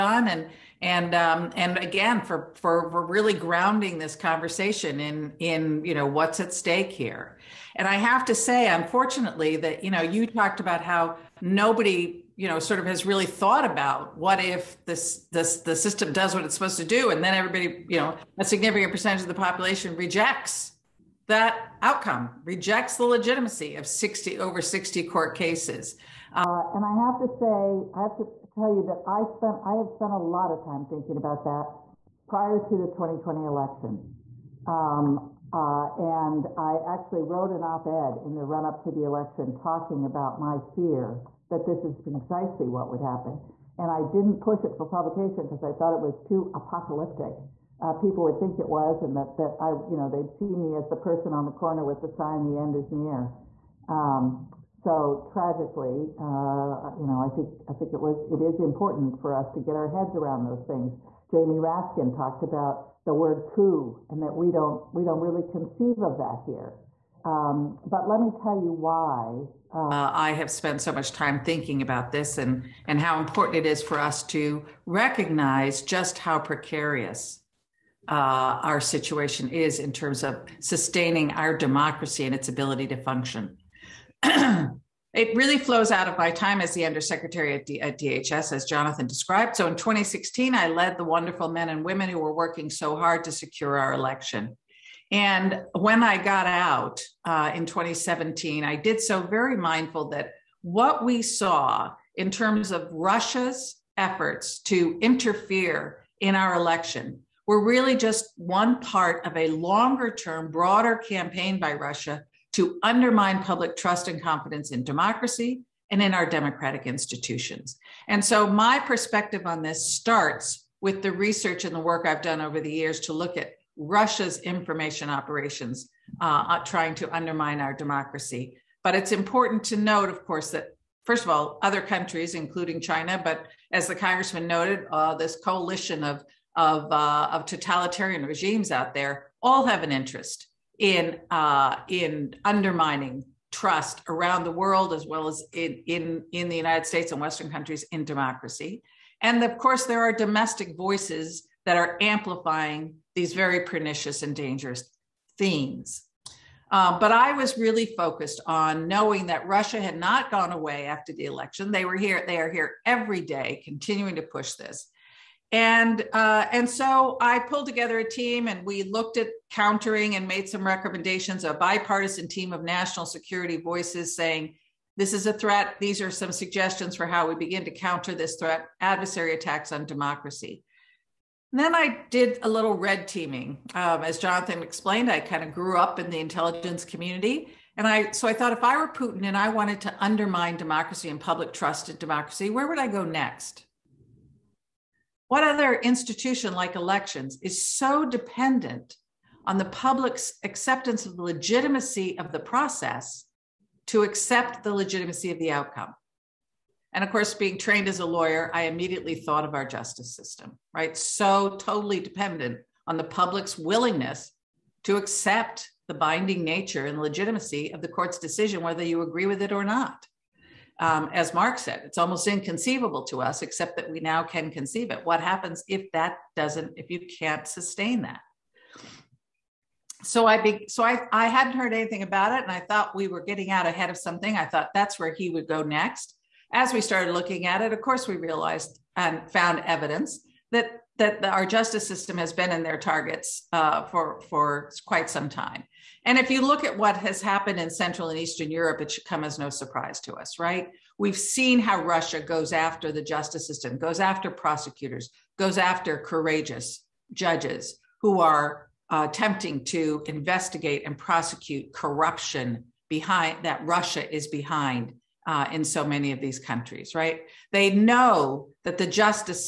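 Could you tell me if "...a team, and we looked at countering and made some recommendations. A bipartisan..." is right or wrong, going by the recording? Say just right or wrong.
right.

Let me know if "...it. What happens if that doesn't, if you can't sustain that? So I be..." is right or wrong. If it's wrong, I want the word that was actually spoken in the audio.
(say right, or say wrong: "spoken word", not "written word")
right.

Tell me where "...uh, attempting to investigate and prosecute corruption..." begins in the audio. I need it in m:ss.
4:18.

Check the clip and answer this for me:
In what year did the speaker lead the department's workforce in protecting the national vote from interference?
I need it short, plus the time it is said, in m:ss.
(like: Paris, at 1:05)
2016, at 1:29.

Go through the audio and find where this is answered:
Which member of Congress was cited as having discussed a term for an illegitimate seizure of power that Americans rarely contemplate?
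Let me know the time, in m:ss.
1:01.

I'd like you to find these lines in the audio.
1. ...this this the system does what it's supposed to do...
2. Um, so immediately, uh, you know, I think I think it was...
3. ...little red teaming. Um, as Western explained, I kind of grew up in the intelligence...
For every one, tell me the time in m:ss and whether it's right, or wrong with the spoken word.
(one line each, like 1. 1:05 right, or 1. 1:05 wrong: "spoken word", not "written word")
1. 0:14 right
2. 0:53 wrong: "tragically", not "immediately"
3. 3:02 wrong: "Jonathan", not "Western".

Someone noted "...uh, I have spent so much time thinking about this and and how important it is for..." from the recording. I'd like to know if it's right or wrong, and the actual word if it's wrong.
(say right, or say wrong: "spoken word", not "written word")
right.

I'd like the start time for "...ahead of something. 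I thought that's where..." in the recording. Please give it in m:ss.
3:53.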